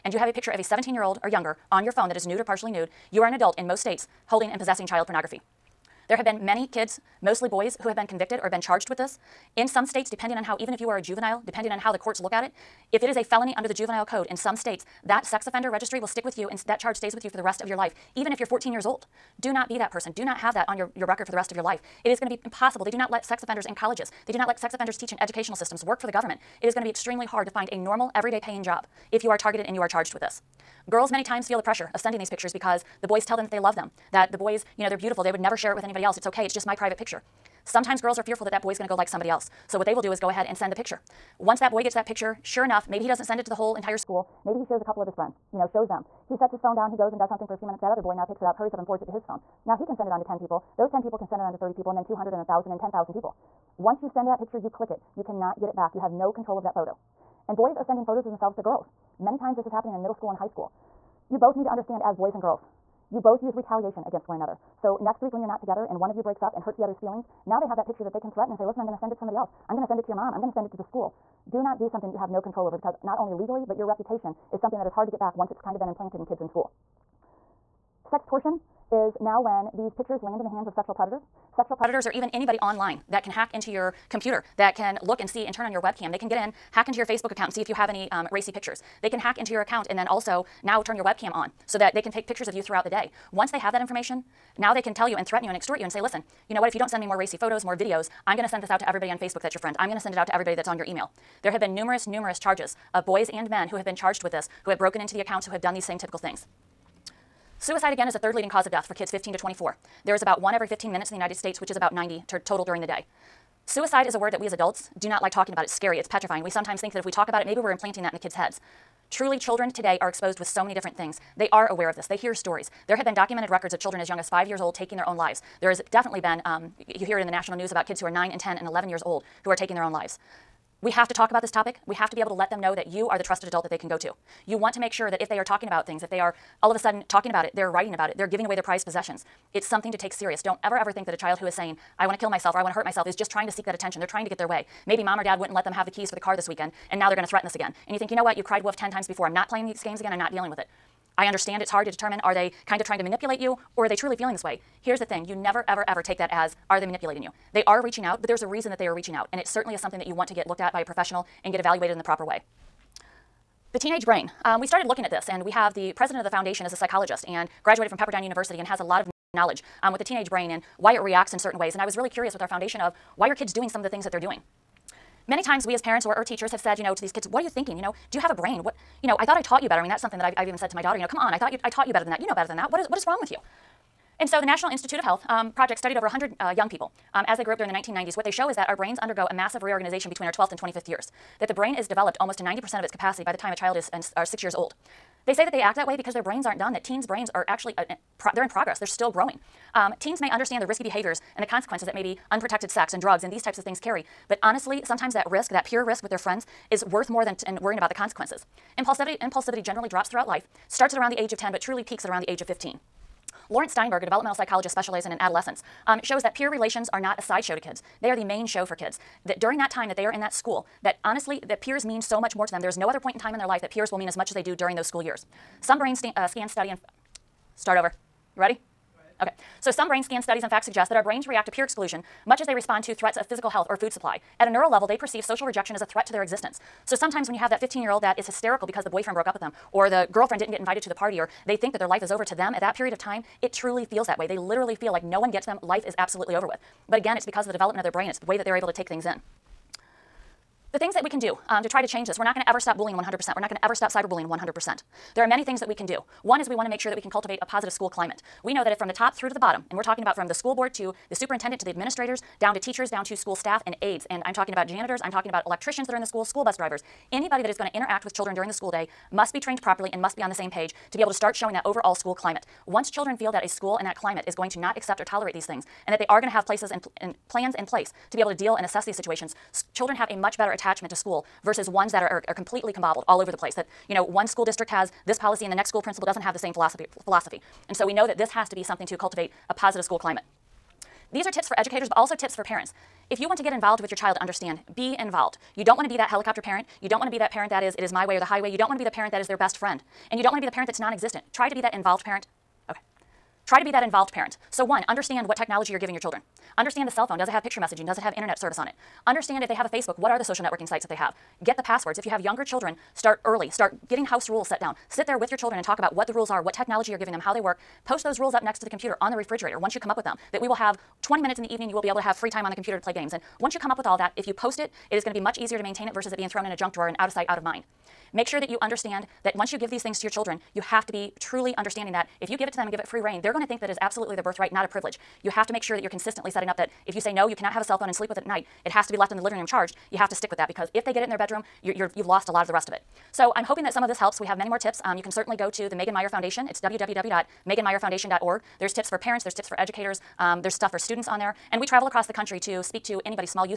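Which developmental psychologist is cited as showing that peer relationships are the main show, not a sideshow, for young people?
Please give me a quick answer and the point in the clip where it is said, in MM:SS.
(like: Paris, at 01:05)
Laurence Steinberg, at 03:33.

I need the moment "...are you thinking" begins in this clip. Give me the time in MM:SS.
02:57.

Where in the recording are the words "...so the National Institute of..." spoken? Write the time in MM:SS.
03:04.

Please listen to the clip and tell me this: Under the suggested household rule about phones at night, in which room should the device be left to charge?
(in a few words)
Living room.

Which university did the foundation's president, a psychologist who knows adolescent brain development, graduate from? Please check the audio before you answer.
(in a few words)
Pepperdine University.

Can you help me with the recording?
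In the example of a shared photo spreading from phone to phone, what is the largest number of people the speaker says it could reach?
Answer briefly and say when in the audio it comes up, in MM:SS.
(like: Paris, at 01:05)
10,000, at 00:52.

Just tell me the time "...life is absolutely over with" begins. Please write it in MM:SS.
04:05.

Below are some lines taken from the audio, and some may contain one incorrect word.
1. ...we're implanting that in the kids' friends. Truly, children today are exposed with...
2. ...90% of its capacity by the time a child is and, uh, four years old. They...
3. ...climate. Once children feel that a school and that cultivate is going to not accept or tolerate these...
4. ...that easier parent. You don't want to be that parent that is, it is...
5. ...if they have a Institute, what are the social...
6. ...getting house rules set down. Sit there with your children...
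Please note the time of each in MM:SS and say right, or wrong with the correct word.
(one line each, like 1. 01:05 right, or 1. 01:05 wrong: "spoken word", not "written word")
1. 01:57 wrong: "heads", not "friends"
2. 03:12 wrong: "six", not "four"
3. 04:32 wrong: "climate", not "cultivate"
4. 04:55 wrong: "helicopter", not "easier"
5. 05:09 wrong: "Facebook", not "Institute"
6. 05:13 right.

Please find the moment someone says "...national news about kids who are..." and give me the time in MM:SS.
02:07.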